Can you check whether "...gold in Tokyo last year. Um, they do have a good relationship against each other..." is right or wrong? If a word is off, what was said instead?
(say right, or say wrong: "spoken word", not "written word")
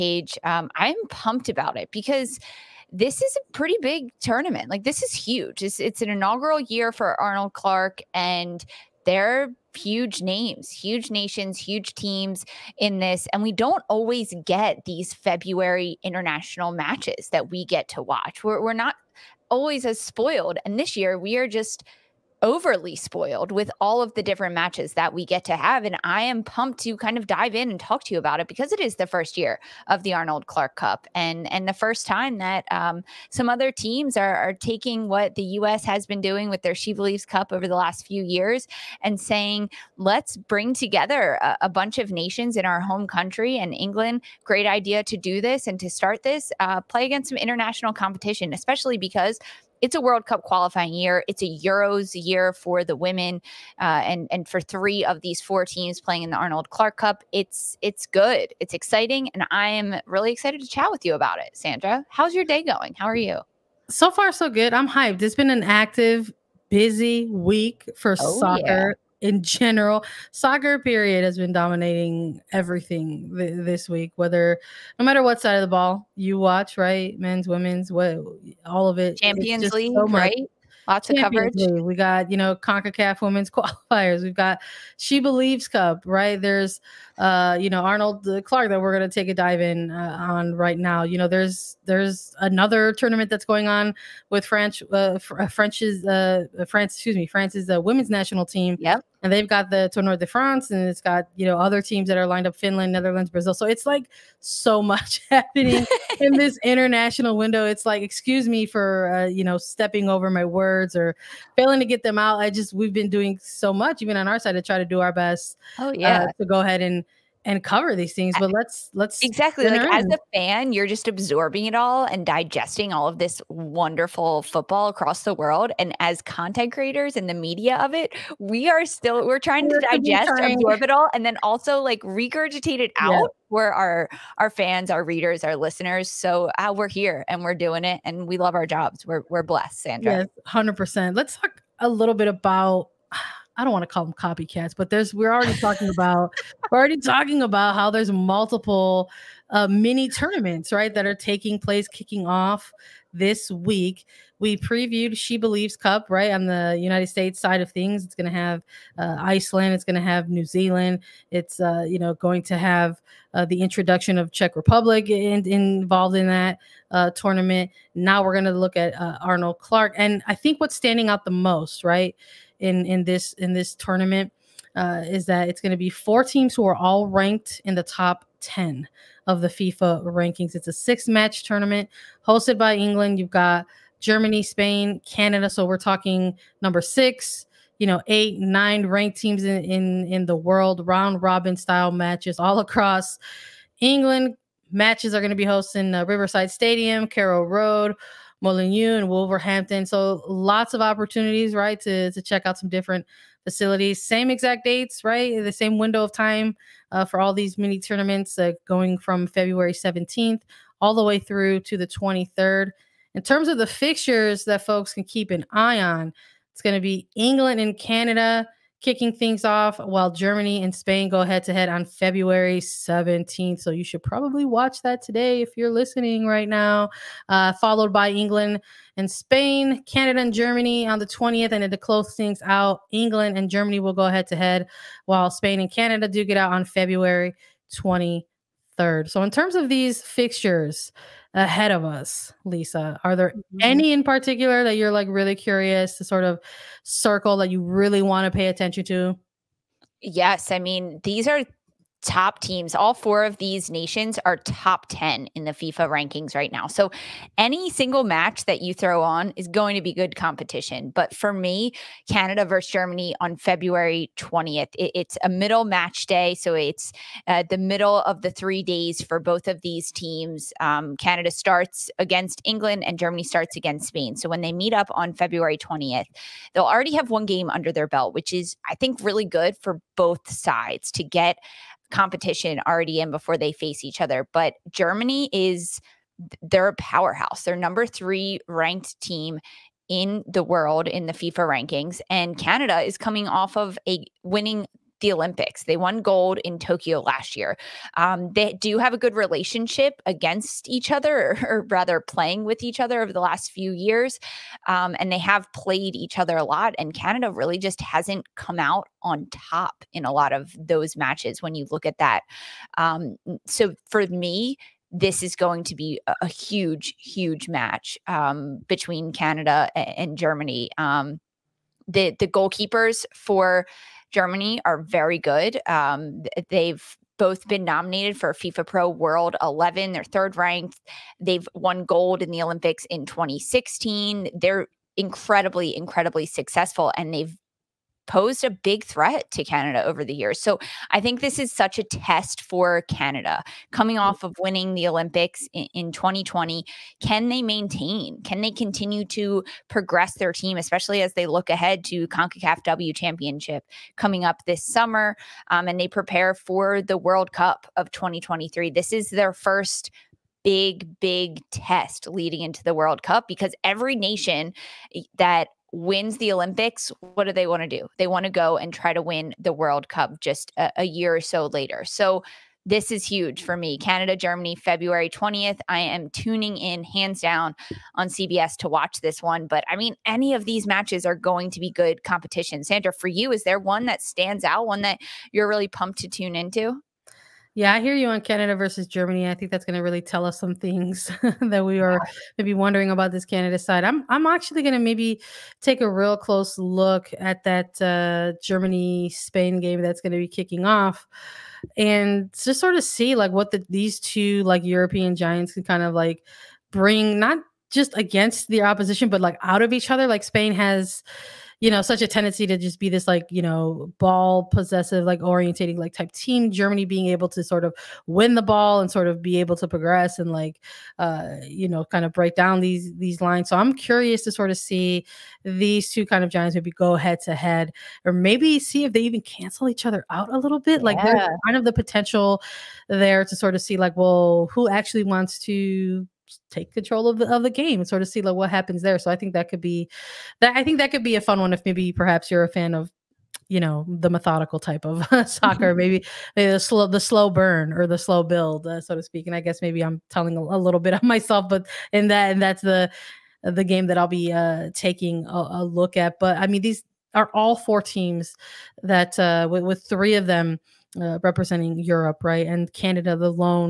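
right.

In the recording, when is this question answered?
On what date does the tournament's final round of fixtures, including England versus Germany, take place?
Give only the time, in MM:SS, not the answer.
03:56.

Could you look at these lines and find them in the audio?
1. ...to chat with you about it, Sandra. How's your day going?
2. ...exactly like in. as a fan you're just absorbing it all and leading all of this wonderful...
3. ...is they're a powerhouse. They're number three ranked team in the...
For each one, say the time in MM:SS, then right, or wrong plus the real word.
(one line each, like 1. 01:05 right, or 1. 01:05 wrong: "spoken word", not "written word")
1. 01:00 right
2. 01:59 wrong: "digesting", not "leading"
3. 04:45 right.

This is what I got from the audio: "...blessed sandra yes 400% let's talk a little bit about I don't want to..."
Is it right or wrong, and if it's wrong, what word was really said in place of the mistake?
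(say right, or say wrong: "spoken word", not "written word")
wrong: "100", not "400".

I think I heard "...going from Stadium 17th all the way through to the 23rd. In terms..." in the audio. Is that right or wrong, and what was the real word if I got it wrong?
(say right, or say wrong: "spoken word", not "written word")
wrong: "February", not "Stadium".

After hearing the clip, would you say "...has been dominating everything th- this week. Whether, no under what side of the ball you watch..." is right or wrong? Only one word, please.
wrong.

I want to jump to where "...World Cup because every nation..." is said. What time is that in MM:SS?
06:02.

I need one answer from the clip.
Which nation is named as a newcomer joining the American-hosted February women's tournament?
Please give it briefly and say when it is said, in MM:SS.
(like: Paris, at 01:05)
Czech Republic, at 02:44.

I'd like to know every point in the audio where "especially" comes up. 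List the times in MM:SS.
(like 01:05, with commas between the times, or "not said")
00:48, 05:50.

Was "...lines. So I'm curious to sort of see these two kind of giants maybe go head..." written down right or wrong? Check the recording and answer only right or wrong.
right.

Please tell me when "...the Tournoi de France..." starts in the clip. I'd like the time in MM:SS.
01:39.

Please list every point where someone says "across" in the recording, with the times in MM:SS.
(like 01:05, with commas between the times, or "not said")
02:04, 03:12.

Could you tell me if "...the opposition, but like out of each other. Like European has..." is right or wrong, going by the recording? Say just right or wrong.
wrong.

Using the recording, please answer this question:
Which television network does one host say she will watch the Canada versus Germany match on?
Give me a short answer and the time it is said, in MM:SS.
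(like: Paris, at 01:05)
CBS, at 06:18.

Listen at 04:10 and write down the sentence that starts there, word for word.
Yes, I mean, these are top teams.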